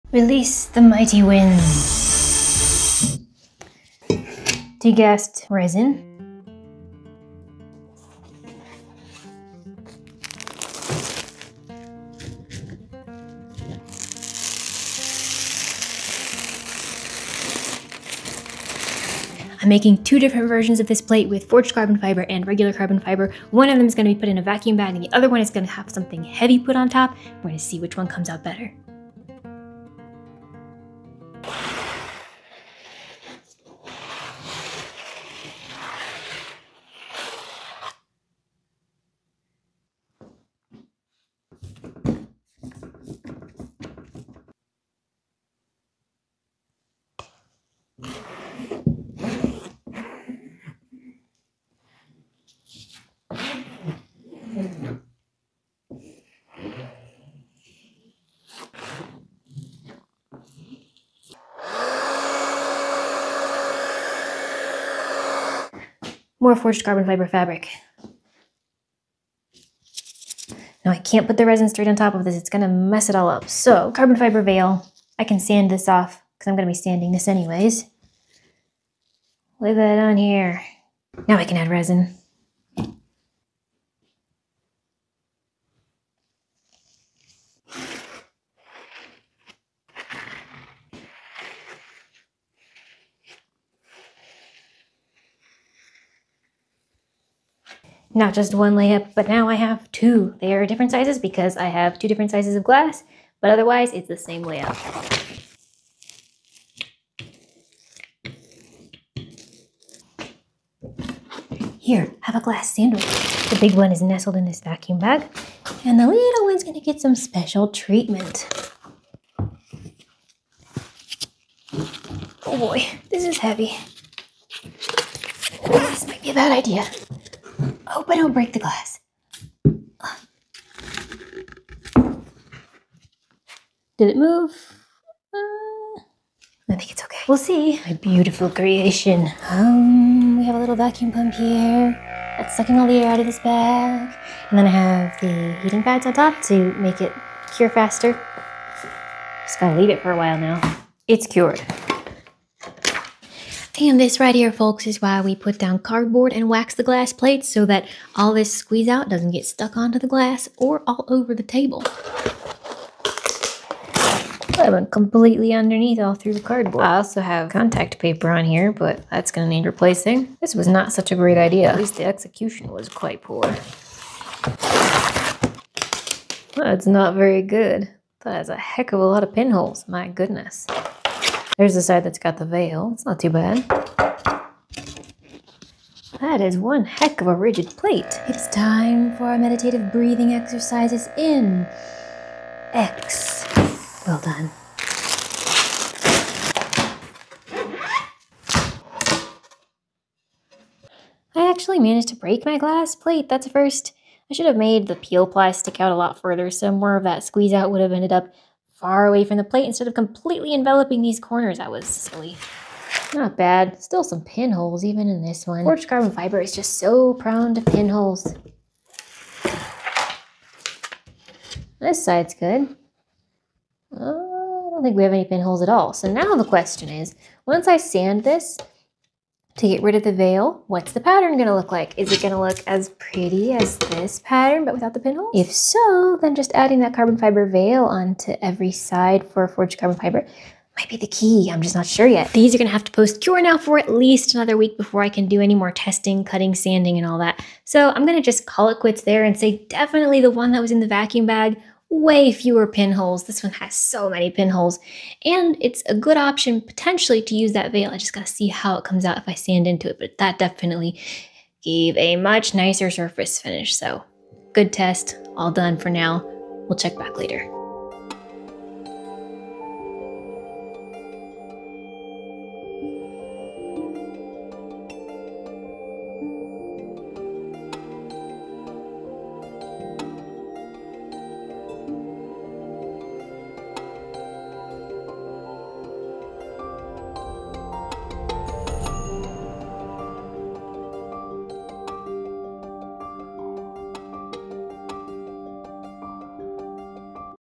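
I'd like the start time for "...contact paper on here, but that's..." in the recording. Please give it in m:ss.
2:47.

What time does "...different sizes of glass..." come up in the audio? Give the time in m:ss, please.
1:42.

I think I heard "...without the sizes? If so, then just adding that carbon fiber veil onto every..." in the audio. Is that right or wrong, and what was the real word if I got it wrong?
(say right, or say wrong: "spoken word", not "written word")
wrong: "pinholes", not "sizes".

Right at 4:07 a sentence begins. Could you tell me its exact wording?
So I'm gonna just call it quits there and say definitely the one that was in the vacuum bag way fewer pinholes.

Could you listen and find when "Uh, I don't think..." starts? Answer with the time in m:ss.
3:43.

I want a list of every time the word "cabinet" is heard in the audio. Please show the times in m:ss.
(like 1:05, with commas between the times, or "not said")
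not said.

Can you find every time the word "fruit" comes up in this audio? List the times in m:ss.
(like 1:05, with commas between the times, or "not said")
not said.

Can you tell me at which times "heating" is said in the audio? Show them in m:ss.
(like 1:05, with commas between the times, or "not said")
2:25.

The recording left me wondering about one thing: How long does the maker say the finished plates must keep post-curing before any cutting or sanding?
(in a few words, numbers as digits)
at least another week.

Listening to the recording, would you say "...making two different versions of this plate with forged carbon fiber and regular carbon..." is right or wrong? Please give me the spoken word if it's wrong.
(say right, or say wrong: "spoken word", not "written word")
right.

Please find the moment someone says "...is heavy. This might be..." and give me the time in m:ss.
2:03.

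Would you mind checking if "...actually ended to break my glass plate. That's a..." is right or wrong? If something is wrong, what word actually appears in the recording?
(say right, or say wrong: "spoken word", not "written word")
wrong: "managed", not "ended".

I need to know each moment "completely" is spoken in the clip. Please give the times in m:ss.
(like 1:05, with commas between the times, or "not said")
2:44, 3:29.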